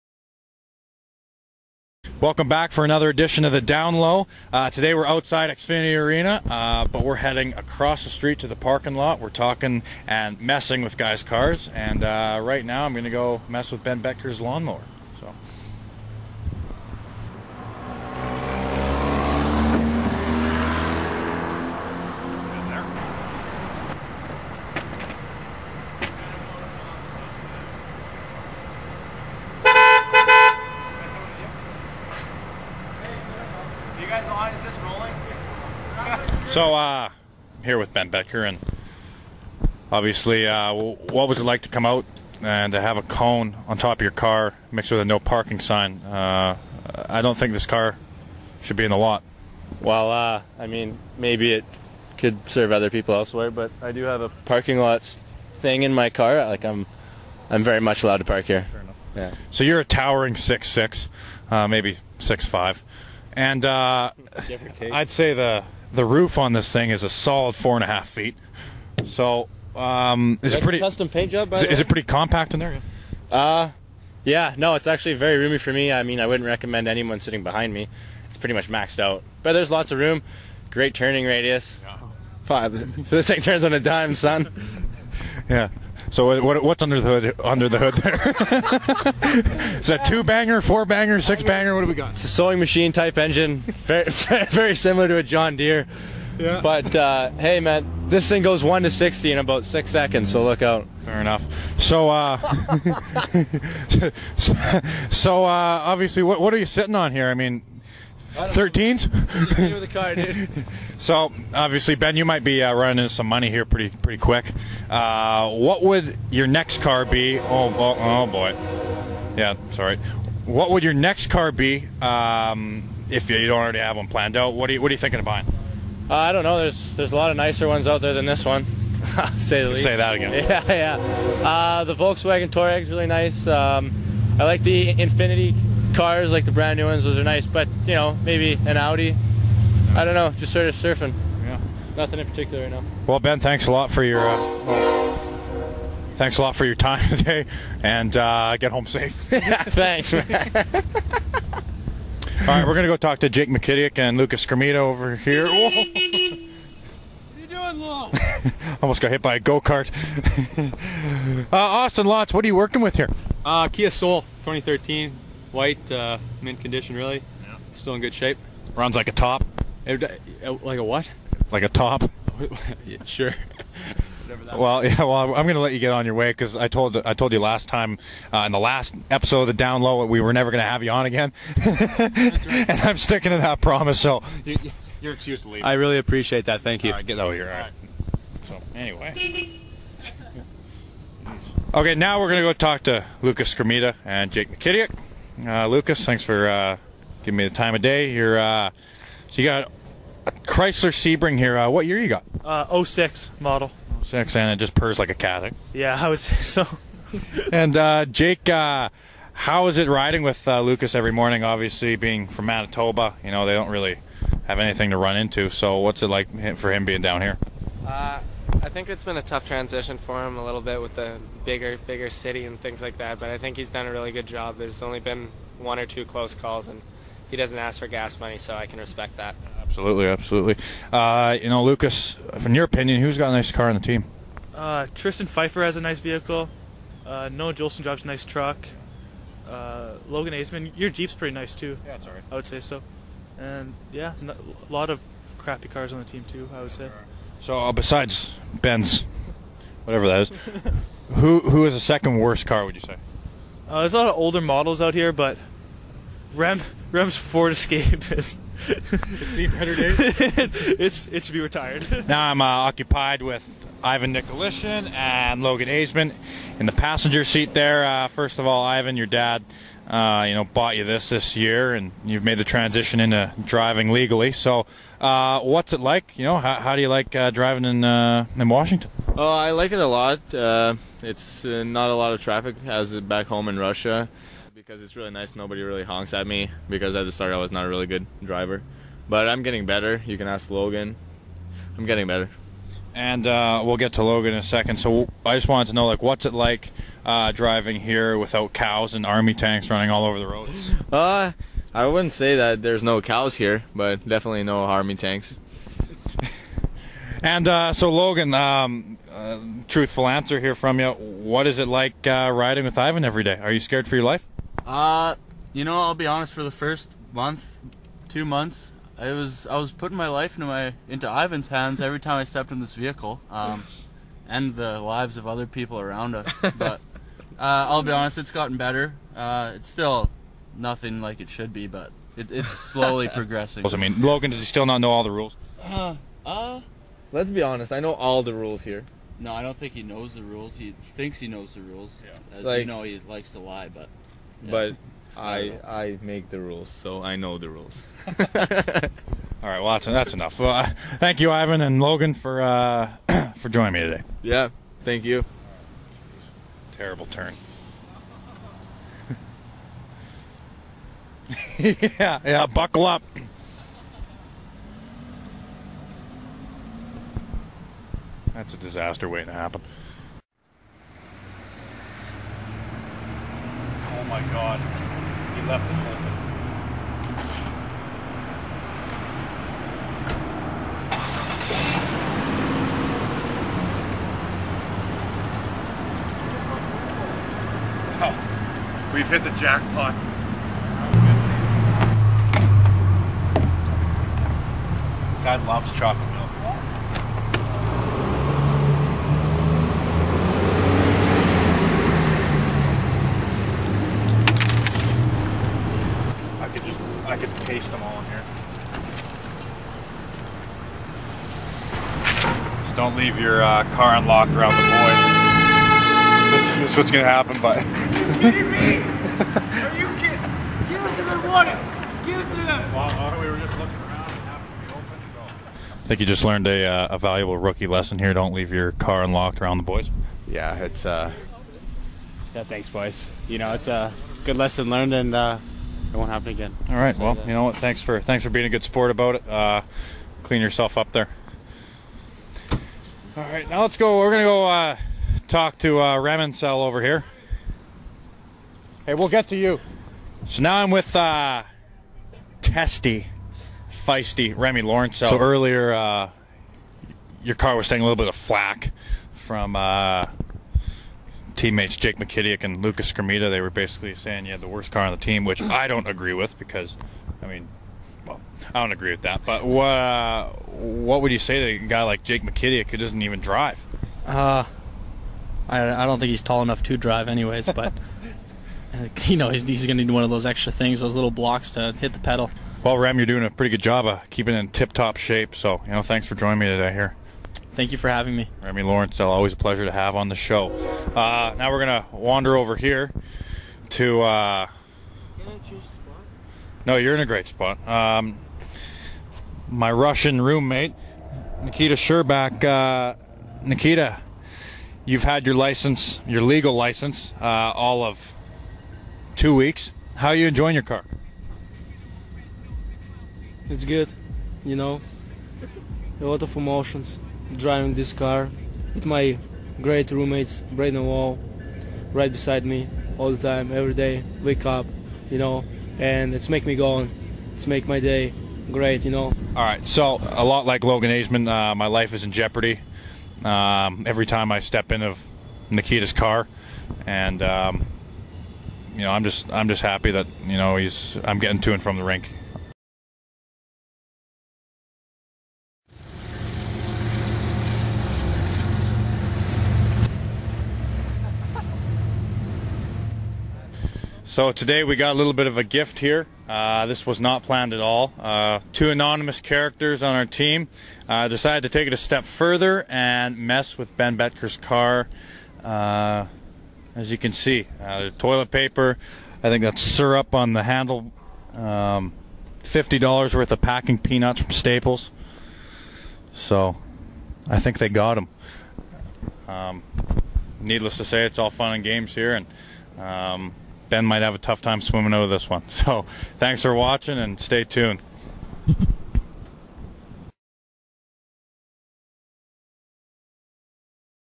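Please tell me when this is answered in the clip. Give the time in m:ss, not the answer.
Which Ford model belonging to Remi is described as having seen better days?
4:17.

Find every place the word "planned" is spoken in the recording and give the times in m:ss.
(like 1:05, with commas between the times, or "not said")
2:04, 9:17.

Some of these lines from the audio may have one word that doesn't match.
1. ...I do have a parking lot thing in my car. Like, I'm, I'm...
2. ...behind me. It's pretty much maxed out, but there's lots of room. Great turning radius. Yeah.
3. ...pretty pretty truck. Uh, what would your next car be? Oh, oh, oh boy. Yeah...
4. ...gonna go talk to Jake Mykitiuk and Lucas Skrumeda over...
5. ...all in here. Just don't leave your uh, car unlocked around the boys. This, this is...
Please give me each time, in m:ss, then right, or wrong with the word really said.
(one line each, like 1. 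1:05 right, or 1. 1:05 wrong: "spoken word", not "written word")
1. 0:53 right
2. 1:17 right
3. 1:53 wrong: "quick", not "truck"
4. 2:32 right
5. 6:47 right.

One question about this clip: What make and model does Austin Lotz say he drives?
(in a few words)
Kia Soul.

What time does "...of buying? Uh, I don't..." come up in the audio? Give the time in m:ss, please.
2:05.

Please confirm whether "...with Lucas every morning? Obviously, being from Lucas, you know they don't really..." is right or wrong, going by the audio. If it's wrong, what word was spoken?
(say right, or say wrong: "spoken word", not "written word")
wrong: "Manitoba", not "Lucas".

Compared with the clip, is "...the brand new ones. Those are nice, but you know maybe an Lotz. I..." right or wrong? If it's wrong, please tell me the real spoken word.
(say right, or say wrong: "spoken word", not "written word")
wrong: "Audi", not "Lotz".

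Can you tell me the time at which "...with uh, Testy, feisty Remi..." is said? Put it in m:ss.
7:30.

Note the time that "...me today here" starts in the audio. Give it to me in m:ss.
8:06.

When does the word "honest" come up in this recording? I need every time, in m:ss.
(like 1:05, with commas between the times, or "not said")
5:16, 5:27, 5:37.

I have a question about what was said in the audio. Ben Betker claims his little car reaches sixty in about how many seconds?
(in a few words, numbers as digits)
6.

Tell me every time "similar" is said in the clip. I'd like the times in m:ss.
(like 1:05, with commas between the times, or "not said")
1:34.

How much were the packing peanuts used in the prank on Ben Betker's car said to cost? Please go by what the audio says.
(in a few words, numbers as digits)
$50.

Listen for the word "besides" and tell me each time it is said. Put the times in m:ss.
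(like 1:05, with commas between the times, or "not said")
4:07, 8:42.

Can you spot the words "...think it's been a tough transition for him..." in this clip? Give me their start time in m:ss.
3:38.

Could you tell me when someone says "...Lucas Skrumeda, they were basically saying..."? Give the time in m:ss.
7:42.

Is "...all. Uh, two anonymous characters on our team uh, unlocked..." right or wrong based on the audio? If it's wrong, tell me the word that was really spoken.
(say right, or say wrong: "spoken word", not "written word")
wrong: "decided", not "unlocked".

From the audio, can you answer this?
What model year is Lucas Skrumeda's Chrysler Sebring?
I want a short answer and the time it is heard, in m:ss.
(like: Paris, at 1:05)
2006, at 3:22.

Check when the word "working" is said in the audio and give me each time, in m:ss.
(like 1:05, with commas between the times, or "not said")
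2:42.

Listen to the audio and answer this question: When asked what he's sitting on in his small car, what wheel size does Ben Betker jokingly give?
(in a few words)
13s.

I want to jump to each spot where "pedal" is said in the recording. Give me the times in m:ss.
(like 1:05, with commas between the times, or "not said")
8:01.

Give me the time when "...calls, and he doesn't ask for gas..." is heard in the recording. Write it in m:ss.
3:46.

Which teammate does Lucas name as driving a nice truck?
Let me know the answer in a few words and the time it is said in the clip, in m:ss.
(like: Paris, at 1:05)
Noah Juulsen, at 3:57.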